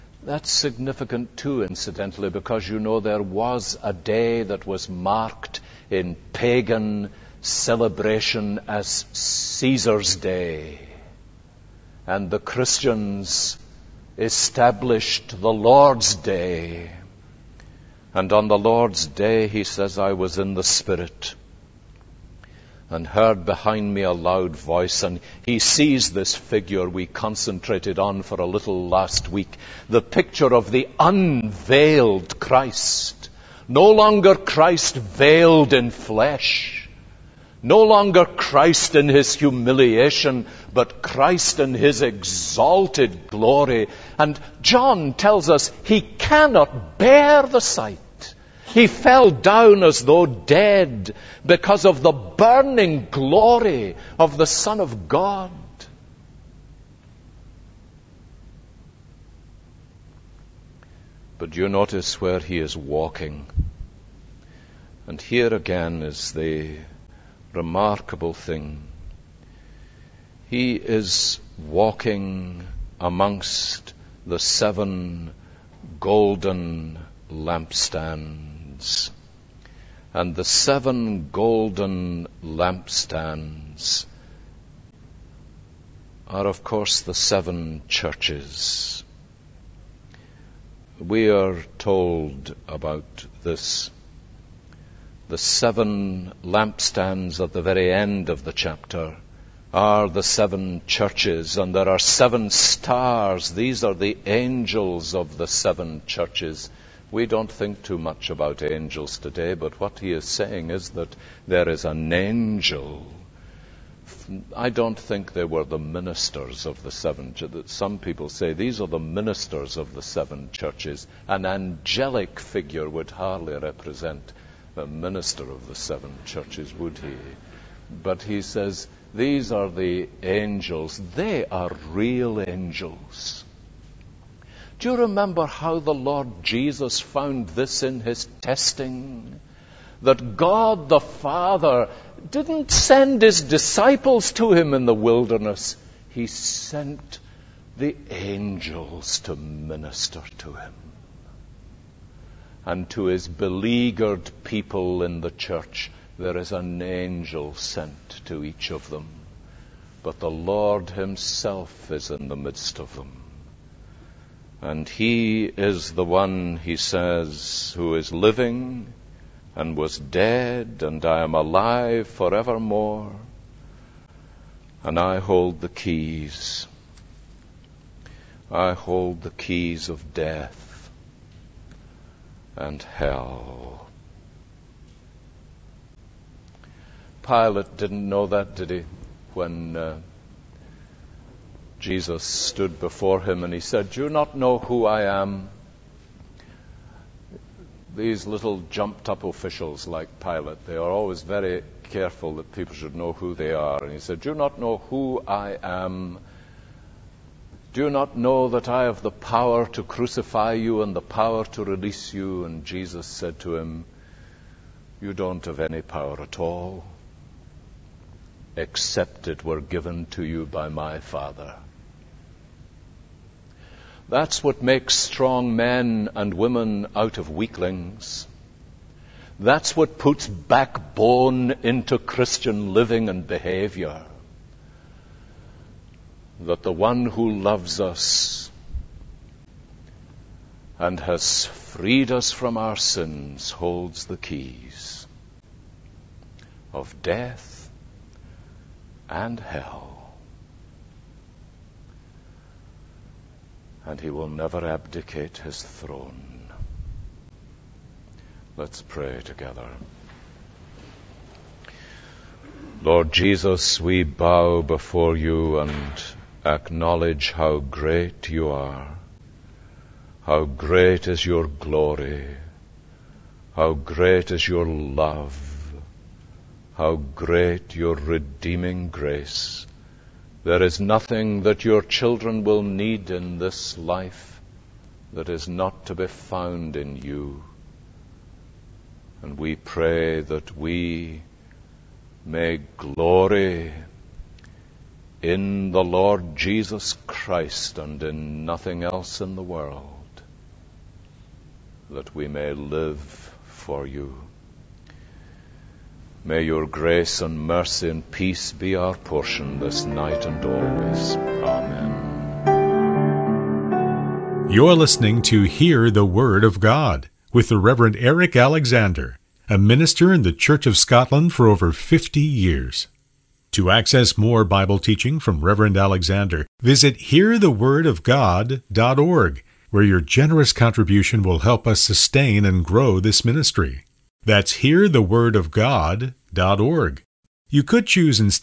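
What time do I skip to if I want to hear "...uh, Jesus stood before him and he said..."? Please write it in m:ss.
3:09.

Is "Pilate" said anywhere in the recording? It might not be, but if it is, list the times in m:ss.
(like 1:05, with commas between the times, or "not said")
3:07, 3:20.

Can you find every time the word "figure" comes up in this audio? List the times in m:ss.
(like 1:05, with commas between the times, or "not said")
0:26, 2:02.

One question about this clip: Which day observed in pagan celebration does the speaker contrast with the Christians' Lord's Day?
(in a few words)
Caesar's Day.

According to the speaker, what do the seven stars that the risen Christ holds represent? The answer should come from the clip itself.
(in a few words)
The angels of the seven churches.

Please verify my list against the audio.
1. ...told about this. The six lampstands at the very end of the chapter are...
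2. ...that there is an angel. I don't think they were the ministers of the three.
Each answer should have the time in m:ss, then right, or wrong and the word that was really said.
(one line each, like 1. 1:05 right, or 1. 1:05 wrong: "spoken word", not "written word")
1. 1:31 wrong: "seven", not "six"
2. 1:50 wrong: "seven", not "three".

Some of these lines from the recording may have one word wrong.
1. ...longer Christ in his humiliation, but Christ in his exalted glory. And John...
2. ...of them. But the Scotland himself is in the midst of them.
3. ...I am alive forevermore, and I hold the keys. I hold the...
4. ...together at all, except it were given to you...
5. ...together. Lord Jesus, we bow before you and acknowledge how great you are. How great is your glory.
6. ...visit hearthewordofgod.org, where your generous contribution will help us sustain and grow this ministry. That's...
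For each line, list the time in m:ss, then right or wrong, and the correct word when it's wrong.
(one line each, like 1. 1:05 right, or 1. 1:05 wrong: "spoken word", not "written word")
1. 0:37 right
2. 2:38 wrong: "Lord", not "Scotland"
3. 2:51 right
4. 3:35 wrong: "power", not "together"
5. 4:19 right
6. 5:26 right.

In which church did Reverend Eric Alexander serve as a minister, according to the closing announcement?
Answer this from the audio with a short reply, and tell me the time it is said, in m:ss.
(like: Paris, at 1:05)
Church of Scotland, at 5:20.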